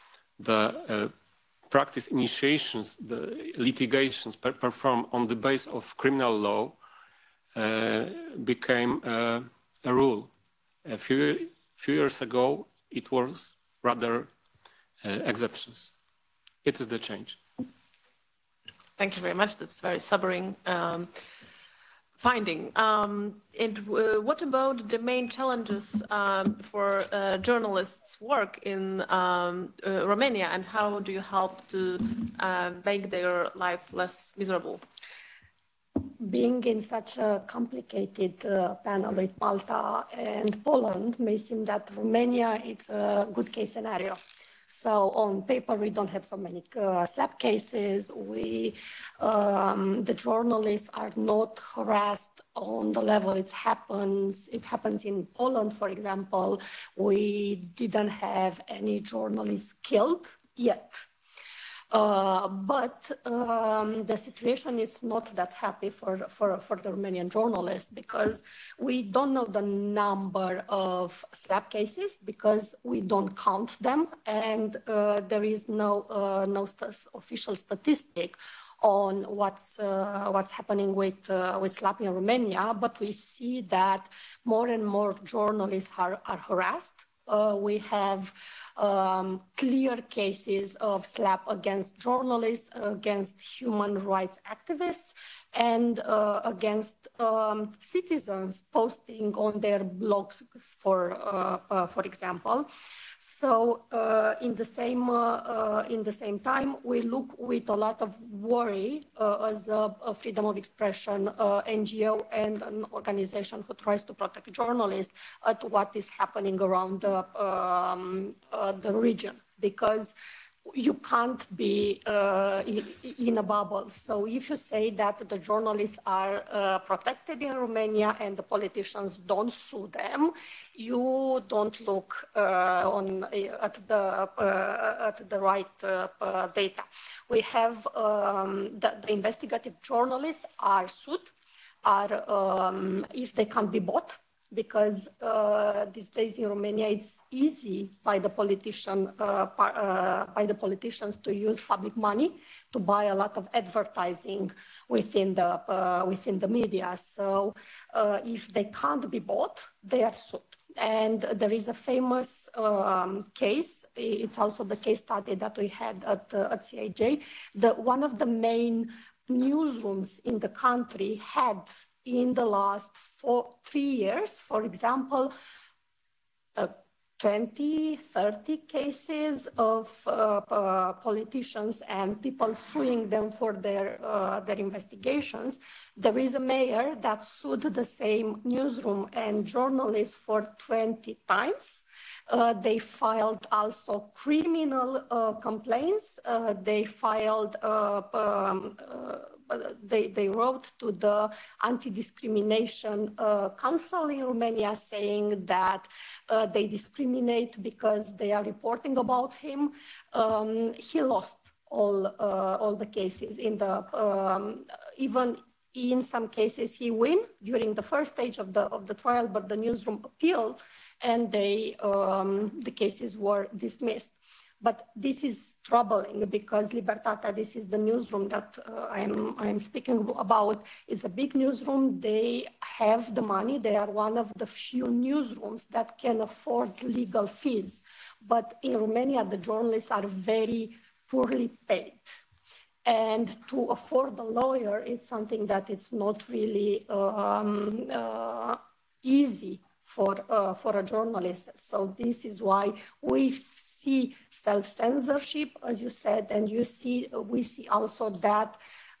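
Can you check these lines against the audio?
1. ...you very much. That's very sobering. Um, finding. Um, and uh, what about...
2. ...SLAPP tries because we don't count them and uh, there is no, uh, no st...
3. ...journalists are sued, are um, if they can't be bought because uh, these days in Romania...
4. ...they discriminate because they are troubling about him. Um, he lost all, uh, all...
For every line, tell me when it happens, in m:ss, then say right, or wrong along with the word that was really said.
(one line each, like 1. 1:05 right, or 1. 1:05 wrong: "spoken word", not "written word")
1. 0:19 right
2. 1:11 wrong: "cases", not "tries"
3. 2:19 right
4. 3:26 wrong: "reporting", not "troubling".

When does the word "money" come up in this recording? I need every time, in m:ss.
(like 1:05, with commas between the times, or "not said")
2:31, 3:53.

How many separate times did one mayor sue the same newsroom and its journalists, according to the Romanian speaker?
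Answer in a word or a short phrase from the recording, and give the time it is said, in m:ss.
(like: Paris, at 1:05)
20, at 3:10.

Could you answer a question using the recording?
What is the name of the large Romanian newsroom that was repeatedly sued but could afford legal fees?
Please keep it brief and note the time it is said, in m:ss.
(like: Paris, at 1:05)
Libertatea, at 3:46.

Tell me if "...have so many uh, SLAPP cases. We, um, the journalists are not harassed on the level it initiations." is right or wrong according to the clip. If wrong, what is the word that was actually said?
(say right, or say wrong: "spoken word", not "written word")
wrong: "happens", not "initiations".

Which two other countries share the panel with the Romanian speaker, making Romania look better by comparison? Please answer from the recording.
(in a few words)
Malta and Poland.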